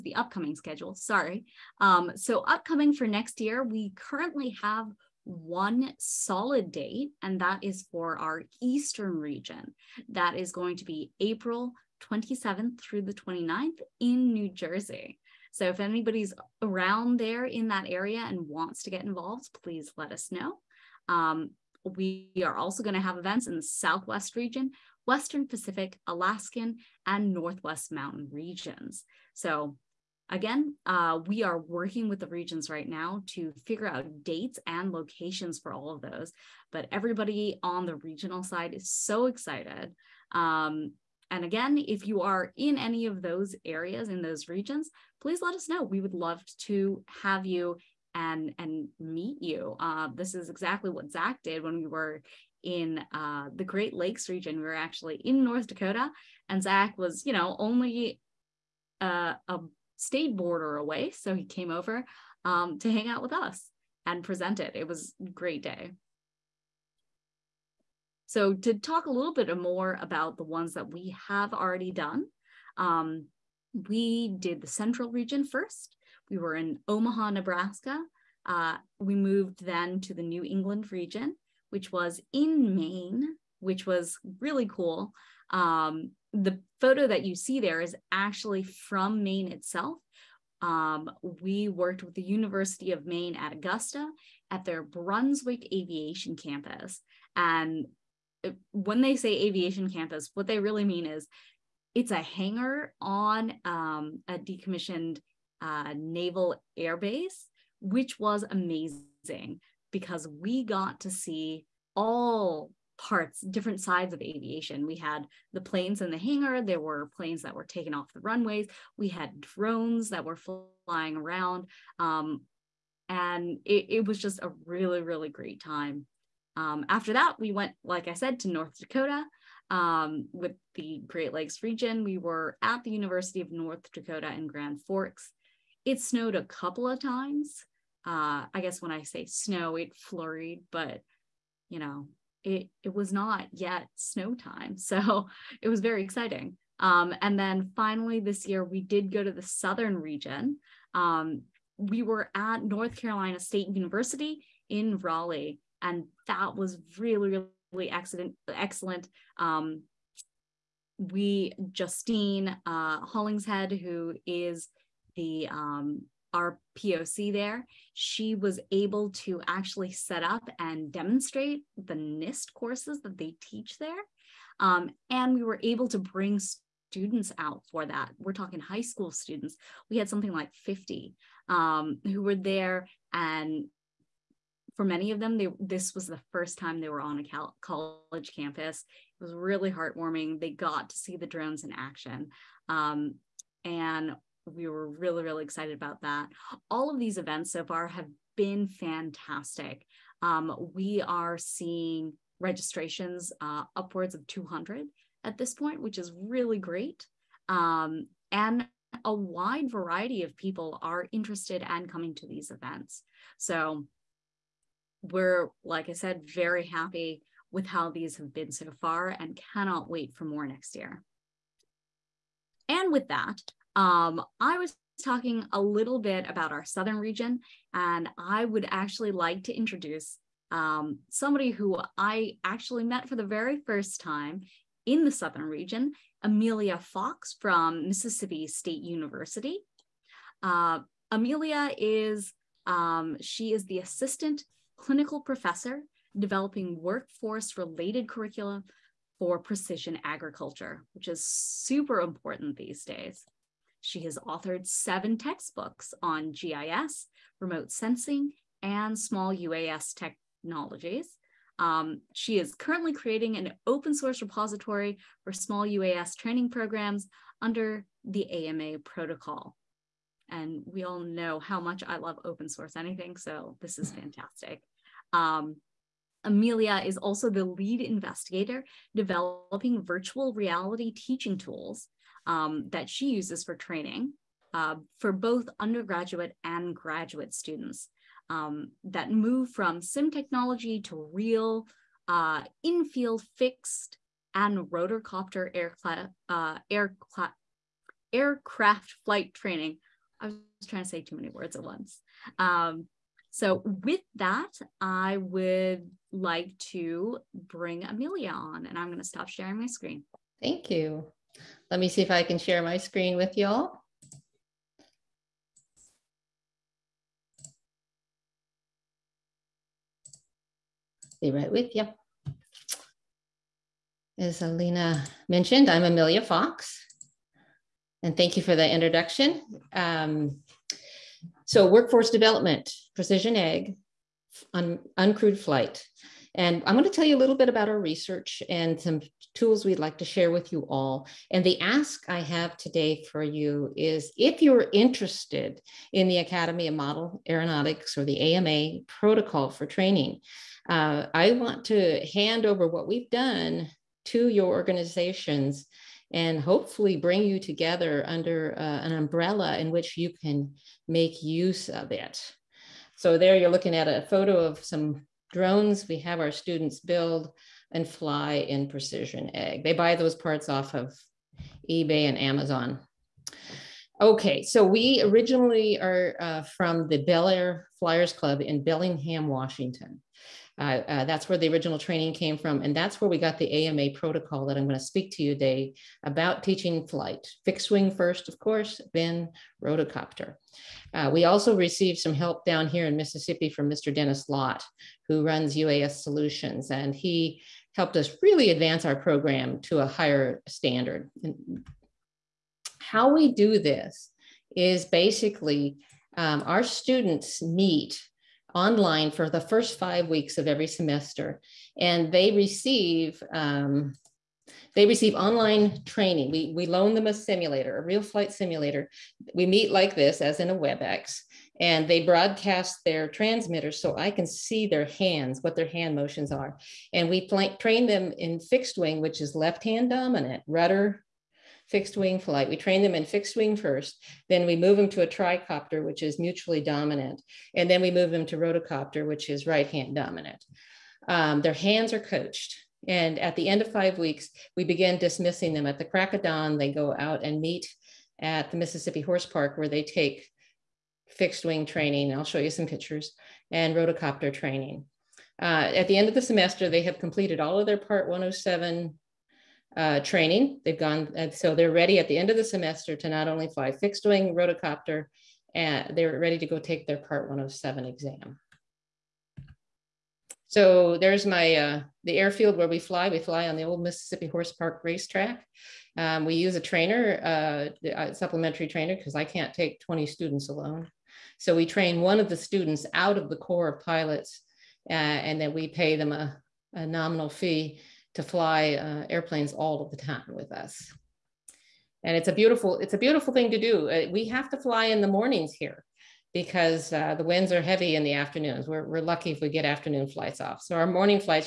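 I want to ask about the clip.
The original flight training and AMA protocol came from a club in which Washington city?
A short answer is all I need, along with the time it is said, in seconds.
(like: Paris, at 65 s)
Bellingham, at 378 s.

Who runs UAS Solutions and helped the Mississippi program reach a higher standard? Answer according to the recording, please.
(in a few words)
Dennis Lott.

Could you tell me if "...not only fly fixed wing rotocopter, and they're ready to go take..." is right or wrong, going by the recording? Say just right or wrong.
right.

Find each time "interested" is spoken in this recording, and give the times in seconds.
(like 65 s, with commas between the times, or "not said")
211 s, 344 s.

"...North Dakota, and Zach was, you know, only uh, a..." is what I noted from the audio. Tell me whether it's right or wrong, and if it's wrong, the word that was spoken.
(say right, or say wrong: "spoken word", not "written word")
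right.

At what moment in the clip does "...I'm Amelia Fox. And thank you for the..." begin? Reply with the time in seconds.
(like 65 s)
325 s.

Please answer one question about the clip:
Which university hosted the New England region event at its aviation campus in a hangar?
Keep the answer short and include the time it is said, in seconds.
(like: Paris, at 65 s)
University of Maine at Augusta, at 92 s.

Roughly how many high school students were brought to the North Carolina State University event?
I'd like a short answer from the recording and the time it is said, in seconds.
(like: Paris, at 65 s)
50, at 180 s.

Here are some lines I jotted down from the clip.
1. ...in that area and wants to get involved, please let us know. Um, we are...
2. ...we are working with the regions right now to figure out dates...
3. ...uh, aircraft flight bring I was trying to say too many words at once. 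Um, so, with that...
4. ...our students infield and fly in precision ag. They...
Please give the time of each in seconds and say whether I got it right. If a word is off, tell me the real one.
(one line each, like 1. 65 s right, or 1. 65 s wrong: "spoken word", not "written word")
1. 17 s right
2. 31 s right
3. 296 s wrong: "training", not "bring"
4. 366 s wrong: "build", not "infield".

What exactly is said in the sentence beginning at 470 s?
So there's my, uh, the airfield where we fly.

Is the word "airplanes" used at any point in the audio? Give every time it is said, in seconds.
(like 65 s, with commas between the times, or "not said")
489 s.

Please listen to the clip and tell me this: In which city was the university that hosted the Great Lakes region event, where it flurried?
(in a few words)
Grand Forks.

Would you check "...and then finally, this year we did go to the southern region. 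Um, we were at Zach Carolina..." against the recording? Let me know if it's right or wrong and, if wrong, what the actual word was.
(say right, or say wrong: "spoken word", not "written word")
wrong: "North", not "Zach".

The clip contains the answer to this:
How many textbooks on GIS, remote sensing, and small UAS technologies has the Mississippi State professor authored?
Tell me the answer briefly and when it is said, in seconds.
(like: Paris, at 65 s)
7, at 254 s.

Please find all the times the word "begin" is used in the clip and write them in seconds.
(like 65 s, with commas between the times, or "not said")
444 s.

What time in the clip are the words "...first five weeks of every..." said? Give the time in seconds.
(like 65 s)
409 s.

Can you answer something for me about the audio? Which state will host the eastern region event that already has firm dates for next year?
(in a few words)
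New Jersey.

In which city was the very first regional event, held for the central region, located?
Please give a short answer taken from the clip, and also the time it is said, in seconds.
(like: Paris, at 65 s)
Omaha, Nebraska, at 76 s.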